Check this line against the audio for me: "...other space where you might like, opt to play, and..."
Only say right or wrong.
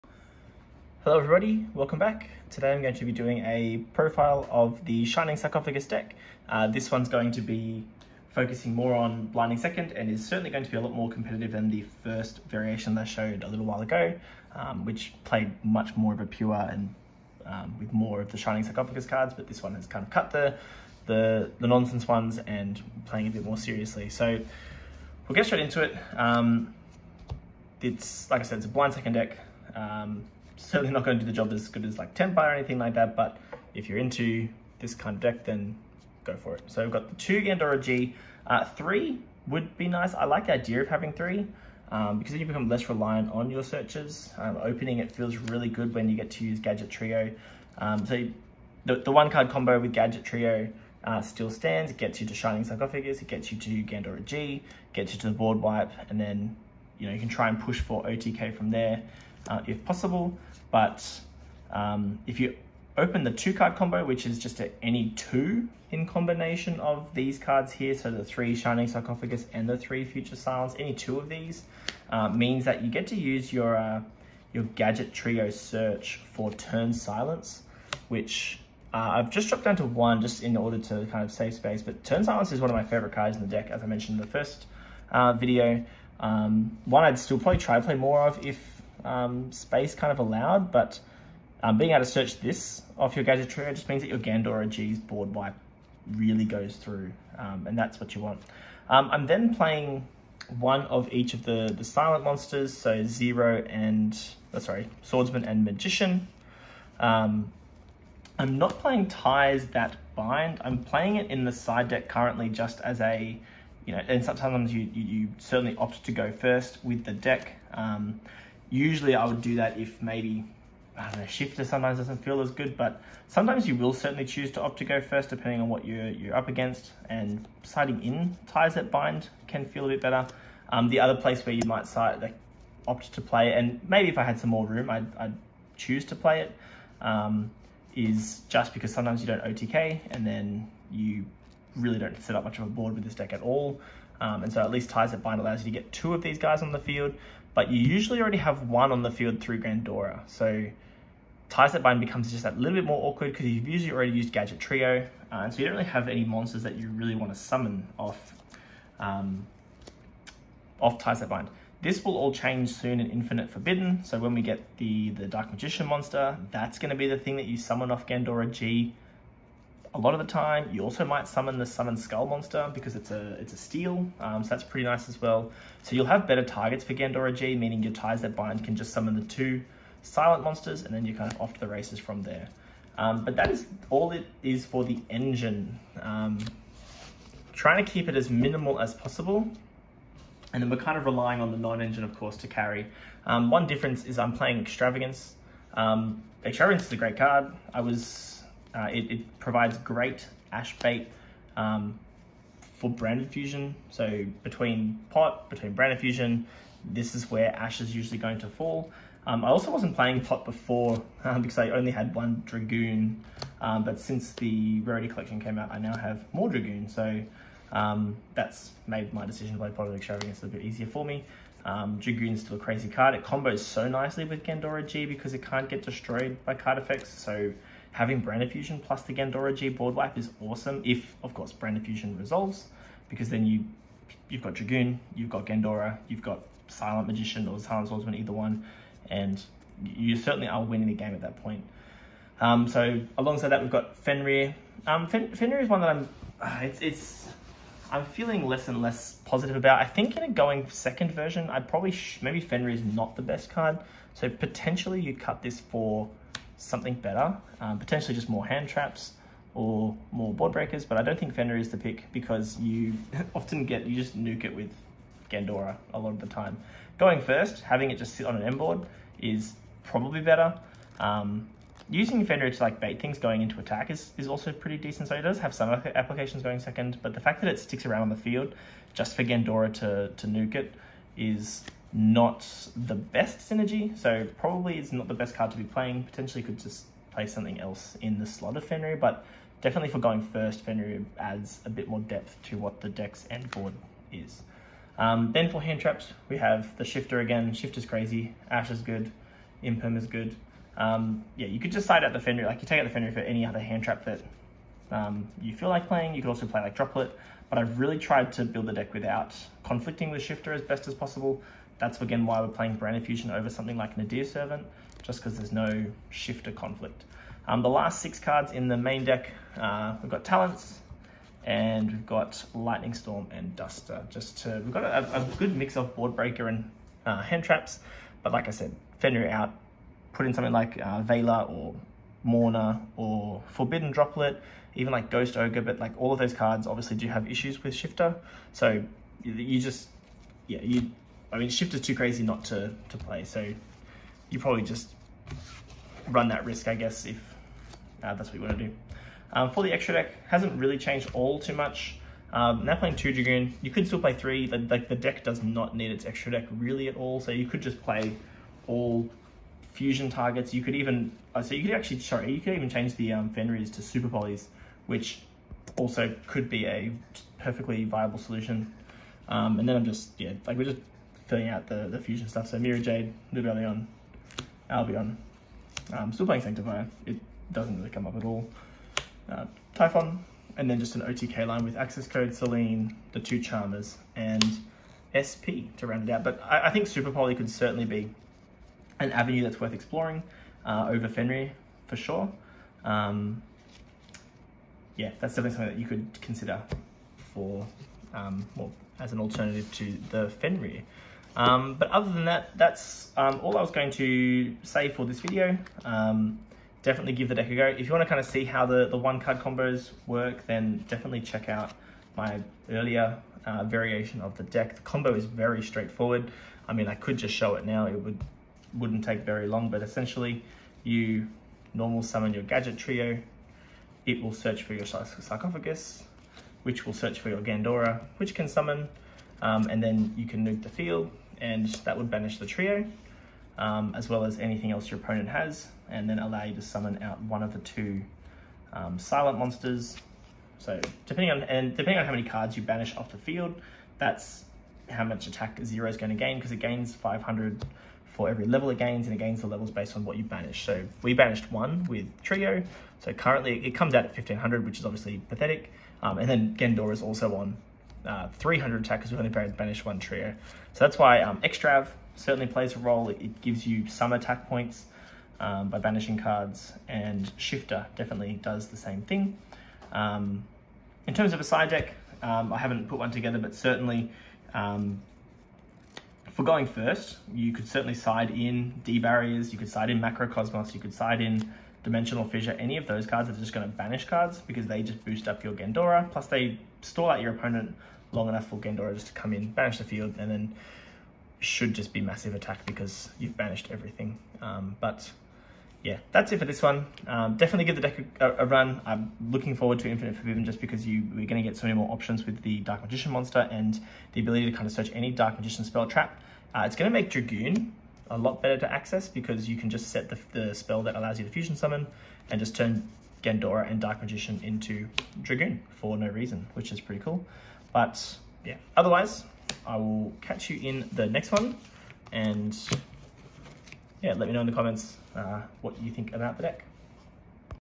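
wrong.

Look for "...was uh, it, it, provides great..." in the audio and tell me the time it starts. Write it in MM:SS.
03:17.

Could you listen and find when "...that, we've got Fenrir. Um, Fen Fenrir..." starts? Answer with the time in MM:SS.
04:03.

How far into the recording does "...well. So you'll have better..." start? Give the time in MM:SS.
02:55.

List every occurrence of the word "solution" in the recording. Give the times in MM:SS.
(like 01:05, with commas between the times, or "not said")
06:08.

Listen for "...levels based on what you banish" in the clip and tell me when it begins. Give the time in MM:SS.
07:29.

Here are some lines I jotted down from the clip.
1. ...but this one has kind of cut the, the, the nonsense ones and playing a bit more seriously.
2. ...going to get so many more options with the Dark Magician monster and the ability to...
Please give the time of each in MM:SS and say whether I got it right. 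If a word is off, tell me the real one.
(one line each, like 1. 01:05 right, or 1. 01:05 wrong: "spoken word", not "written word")
1. 00:19 right
2. 08:21 right.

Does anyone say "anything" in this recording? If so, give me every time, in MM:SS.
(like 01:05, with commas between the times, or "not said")
00:32, 07:14.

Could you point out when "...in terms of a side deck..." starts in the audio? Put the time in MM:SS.
07:51.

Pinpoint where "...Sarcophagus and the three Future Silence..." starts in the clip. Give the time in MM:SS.
01:08.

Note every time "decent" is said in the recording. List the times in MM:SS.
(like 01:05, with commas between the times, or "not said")
04:34.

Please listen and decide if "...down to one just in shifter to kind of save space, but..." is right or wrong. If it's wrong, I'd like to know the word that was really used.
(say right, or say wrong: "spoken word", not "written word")
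wrong: "order", not "shifter".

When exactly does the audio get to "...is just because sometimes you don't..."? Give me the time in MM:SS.
02:17.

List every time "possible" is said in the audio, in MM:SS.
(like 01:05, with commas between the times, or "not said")
00:59, 03:08, 05:10.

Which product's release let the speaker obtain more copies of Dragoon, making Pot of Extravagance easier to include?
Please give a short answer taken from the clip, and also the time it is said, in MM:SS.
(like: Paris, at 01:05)
Rarity Collection, at 03:34.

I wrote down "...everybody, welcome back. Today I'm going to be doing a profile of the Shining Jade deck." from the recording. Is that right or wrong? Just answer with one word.
wrong.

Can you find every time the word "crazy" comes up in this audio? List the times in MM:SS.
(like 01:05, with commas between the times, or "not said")
03:42, 04:57, 05:41.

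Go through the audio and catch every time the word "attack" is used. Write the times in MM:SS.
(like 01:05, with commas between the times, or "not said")
04:33, 07:25, 07:38, 07:44, 08:12.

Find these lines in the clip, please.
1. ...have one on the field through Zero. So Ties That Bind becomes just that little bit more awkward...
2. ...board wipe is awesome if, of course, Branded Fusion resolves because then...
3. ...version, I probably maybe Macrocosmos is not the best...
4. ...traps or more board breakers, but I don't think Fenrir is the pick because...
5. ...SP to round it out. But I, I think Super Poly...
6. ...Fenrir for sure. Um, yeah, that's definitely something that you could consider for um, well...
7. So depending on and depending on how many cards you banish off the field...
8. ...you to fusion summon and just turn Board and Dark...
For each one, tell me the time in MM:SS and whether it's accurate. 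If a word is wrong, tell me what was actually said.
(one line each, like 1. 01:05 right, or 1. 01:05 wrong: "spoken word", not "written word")
1. 02:28 wrong: "Gandora", not "Zero"
2. 03:49 right
3. 04:11 wrong: "Fenrir", not "Macrocosmos"
4. 04:18 right
5. 06:25 right
6. 06:31 right
7. 07:20 right
8. 08:31 wrong: "Gandora", not "Board".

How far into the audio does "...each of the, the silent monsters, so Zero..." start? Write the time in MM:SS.
01:41.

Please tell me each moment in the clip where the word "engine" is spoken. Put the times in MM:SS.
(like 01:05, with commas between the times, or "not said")
03:05, 03:11.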